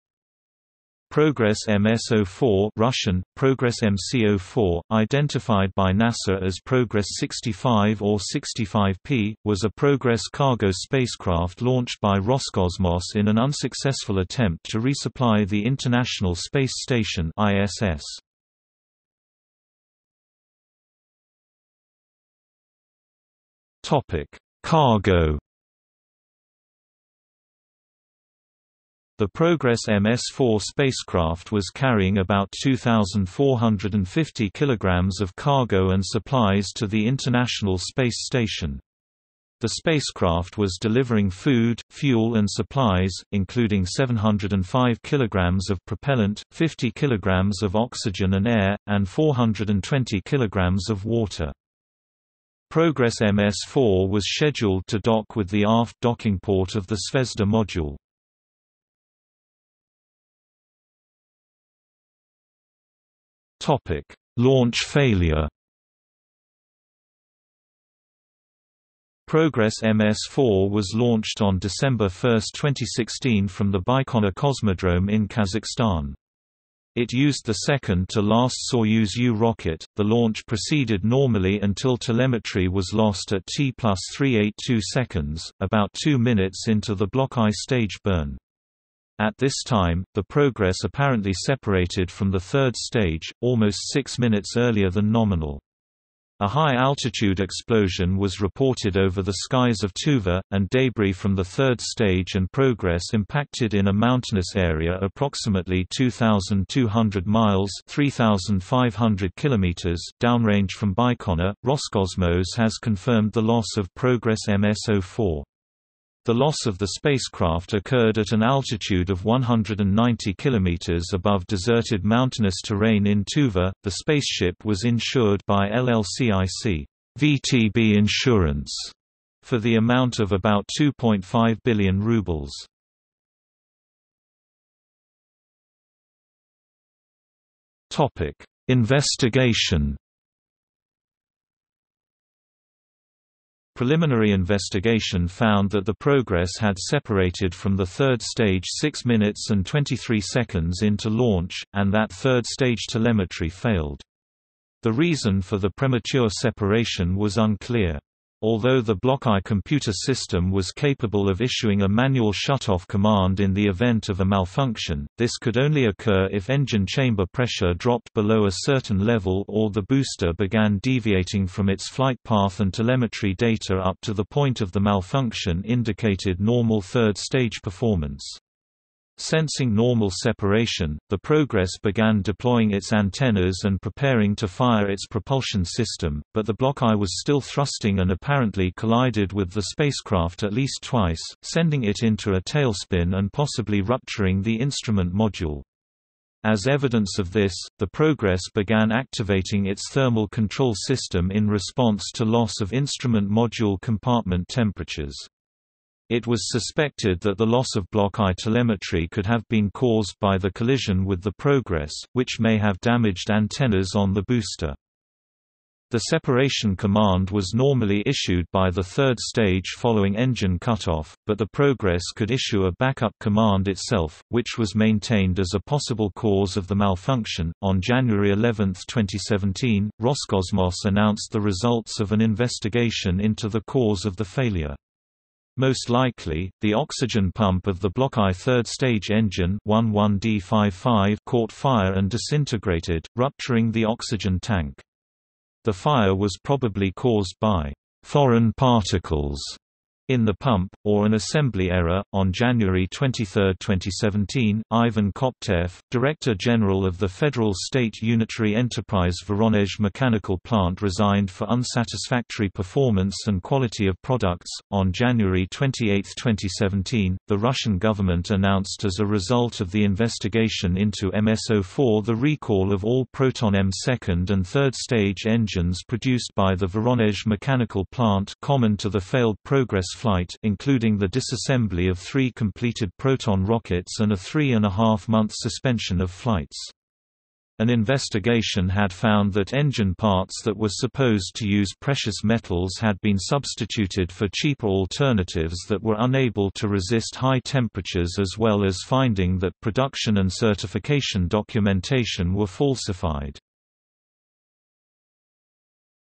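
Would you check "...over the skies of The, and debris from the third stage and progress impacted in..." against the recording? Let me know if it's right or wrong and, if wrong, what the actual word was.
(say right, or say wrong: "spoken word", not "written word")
wrong: "Tuva", not "The".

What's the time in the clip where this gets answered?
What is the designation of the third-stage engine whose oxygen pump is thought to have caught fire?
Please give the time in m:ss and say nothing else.
3:59.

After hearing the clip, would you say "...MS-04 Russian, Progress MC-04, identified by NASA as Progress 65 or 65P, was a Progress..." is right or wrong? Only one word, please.
right.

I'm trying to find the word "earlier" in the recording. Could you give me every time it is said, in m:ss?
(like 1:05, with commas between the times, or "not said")
1:34.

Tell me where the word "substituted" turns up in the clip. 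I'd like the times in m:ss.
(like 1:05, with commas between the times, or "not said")
4:53.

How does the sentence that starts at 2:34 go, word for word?
The reason for the premature separation was unclear.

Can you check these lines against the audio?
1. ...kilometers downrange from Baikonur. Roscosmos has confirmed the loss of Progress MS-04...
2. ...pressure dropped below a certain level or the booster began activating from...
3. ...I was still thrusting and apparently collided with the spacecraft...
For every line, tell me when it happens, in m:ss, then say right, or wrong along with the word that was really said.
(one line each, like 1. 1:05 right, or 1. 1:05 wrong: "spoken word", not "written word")
1. 1:49 right
2. 2:47 wrong: "deviating", not "activating"
3. 3:06 right.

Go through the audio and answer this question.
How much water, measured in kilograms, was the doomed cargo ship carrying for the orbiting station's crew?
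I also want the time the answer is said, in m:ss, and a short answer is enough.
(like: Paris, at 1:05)
420 kilograms, at 0:49.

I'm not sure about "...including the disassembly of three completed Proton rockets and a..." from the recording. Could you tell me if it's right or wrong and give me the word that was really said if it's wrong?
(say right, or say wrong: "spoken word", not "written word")
right.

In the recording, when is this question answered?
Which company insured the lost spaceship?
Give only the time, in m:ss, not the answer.
2:05.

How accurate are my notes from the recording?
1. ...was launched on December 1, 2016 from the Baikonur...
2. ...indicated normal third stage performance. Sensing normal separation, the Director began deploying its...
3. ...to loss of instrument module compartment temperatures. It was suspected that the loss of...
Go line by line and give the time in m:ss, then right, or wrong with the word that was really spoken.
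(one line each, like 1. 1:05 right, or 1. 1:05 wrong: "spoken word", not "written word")
1. 1:10 right
2. 2:55 wrong: "Progress", not "Director"
3. 3:22 right.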